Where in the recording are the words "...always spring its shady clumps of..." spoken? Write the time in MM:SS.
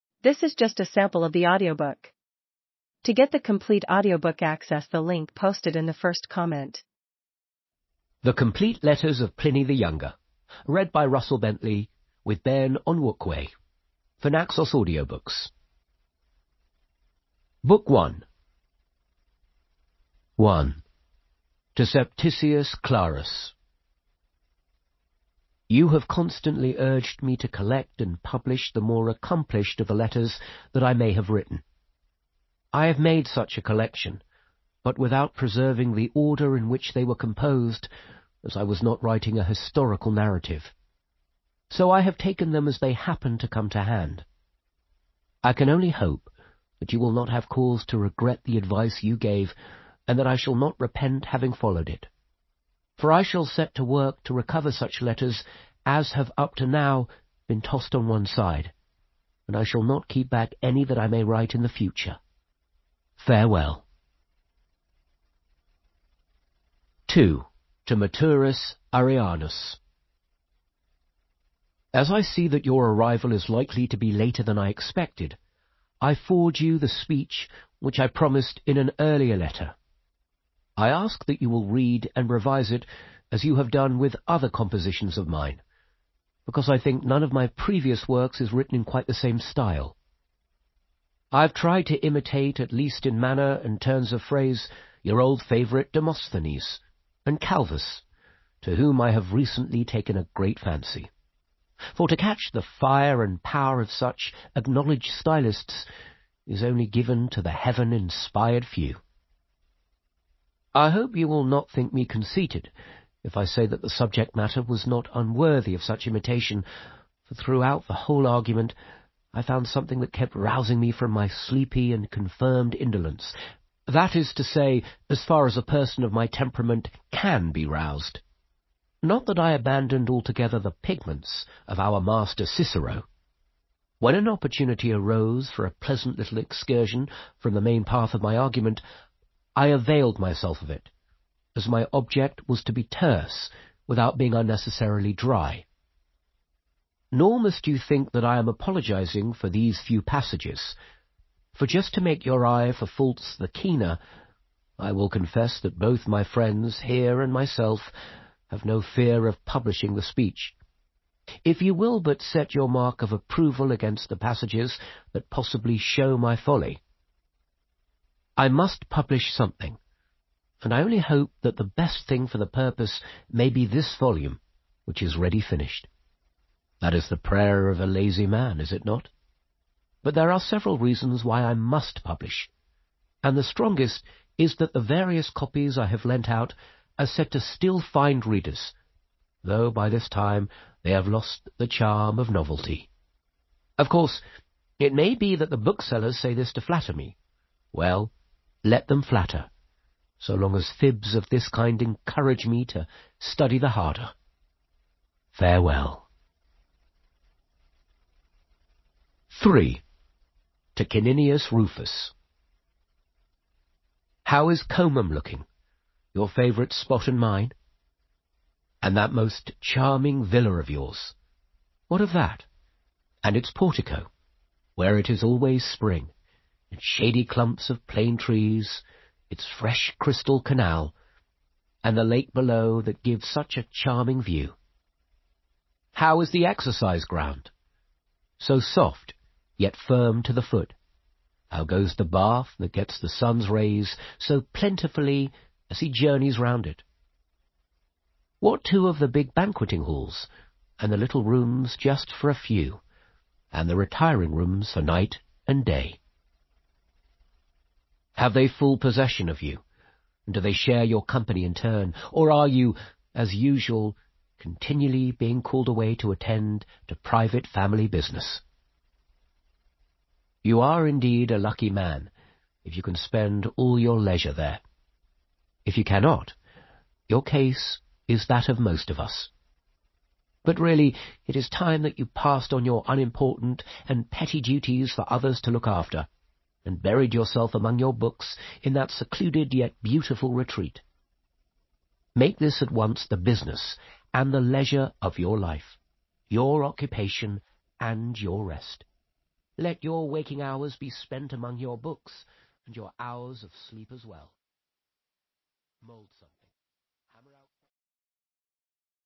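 03:45.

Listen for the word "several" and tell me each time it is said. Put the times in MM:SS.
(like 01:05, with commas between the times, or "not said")
03:00.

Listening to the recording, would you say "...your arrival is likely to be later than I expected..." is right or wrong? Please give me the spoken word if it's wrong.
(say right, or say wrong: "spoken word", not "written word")
right.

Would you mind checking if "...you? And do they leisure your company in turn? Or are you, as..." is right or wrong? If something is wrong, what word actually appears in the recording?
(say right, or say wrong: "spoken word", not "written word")
wrong: "share", not "leisure".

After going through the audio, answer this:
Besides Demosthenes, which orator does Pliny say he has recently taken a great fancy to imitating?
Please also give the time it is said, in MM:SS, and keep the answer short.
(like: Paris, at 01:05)
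Calvus, at 01:37.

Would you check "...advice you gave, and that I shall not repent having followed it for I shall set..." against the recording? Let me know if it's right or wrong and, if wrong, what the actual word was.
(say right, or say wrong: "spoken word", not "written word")
right.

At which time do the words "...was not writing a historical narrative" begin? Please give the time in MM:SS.
00:38.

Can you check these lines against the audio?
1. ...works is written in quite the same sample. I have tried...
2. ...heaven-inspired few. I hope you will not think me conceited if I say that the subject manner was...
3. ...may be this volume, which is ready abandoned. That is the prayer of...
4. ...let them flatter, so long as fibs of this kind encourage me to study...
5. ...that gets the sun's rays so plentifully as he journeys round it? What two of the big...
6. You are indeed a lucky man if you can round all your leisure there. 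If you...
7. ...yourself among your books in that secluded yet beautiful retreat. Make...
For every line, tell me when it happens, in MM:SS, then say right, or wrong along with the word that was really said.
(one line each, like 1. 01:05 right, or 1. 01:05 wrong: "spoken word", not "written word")
1. 01:28 wrong: "style", not "sample"
2. 01:47 wrong: "matter", not "manner"
3. 02:53 wrong: "finished", not "abandoned"
4. 03:18 right
5. 04:02 right
6. 04:30 wrong: "spend", not "round"
7. 04:47 right.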